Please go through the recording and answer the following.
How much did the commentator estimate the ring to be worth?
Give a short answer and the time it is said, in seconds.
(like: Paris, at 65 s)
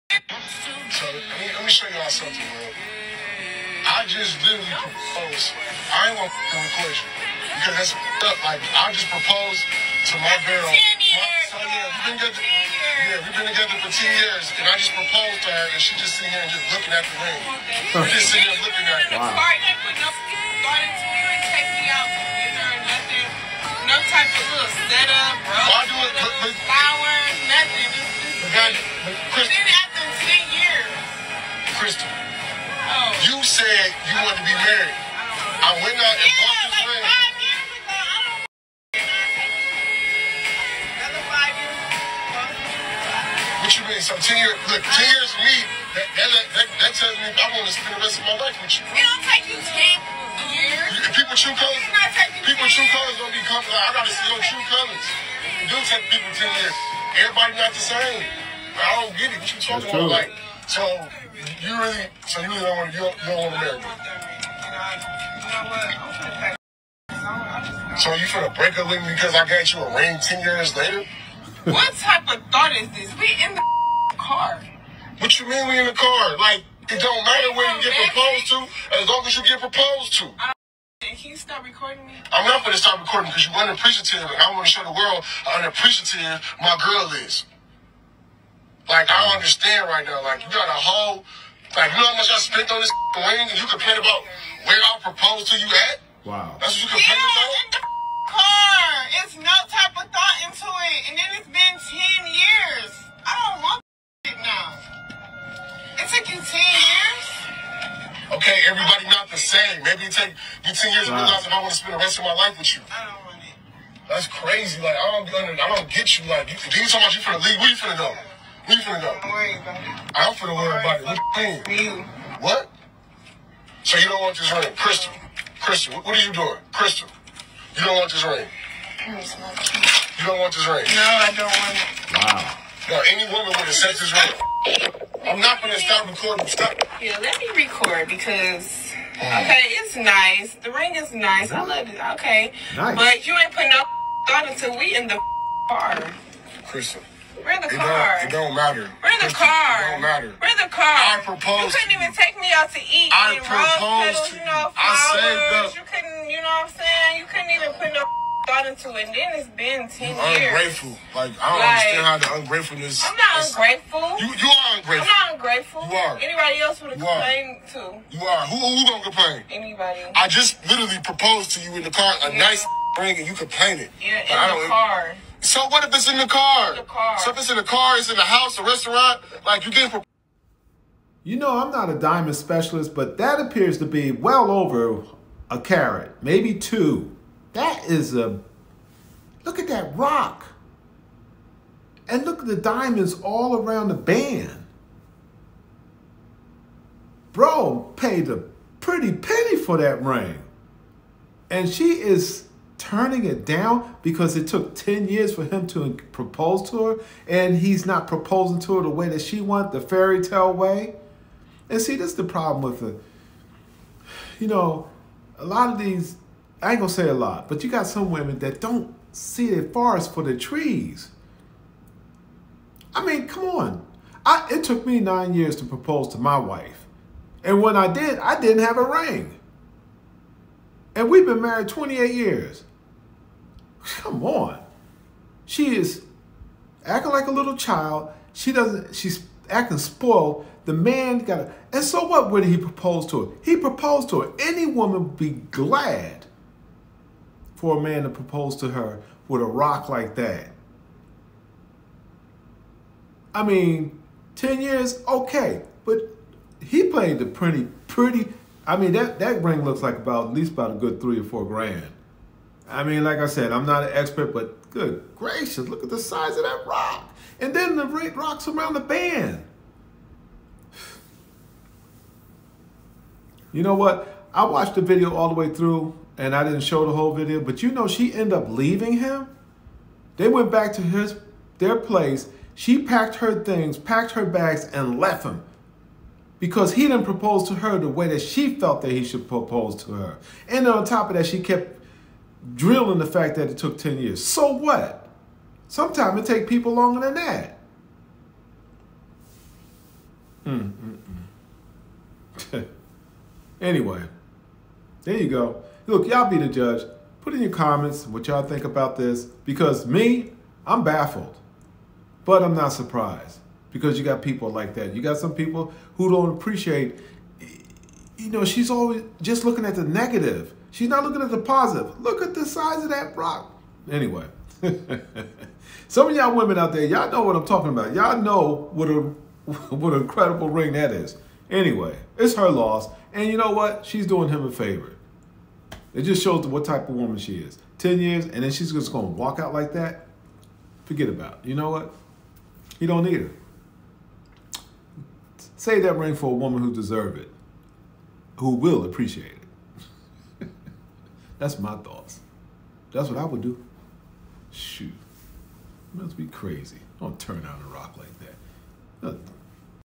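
3 or 4 grand, at 261 s.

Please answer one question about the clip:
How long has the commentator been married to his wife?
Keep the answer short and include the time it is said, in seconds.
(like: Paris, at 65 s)
28 years, at 231 s.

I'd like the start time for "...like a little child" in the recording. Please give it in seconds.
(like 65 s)
237 s.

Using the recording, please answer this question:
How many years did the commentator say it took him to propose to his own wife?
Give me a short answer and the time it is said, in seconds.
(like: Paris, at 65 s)
9 years, at 224 s.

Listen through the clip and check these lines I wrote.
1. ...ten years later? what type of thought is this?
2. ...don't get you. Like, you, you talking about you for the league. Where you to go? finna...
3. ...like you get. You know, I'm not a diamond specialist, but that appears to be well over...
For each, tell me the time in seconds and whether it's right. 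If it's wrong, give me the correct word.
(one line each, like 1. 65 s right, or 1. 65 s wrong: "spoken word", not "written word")
1. 70 s right
2. 115 s right
3. 179 s right.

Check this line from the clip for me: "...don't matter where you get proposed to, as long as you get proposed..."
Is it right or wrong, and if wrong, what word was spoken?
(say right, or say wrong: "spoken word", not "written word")
right.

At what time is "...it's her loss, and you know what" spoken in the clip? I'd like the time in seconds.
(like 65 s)
332 s.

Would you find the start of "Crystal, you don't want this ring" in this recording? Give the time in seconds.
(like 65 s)
126 s.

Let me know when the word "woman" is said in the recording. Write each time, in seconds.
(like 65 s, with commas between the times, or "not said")
133 s, 244 s, 336 s, 346 s.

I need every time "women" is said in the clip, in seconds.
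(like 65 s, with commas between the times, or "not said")
218 s, 326 s.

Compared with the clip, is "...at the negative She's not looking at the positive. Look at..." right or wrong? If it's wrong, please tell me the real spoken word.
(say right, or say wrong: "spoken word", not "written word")
right.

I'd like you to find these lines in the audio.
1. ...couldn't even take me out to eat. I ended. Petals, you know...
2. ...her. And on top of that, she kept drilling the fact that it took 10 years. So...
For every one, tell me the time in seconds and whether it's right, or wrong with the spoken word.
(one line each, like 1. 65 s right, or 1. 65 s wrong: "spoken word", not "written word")
1. 151 s wrong: "proposed", not "ended"
2. 289 s right.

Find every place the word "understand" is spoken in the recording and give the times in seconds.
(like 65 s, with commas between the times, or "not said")
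89 s, 161 s.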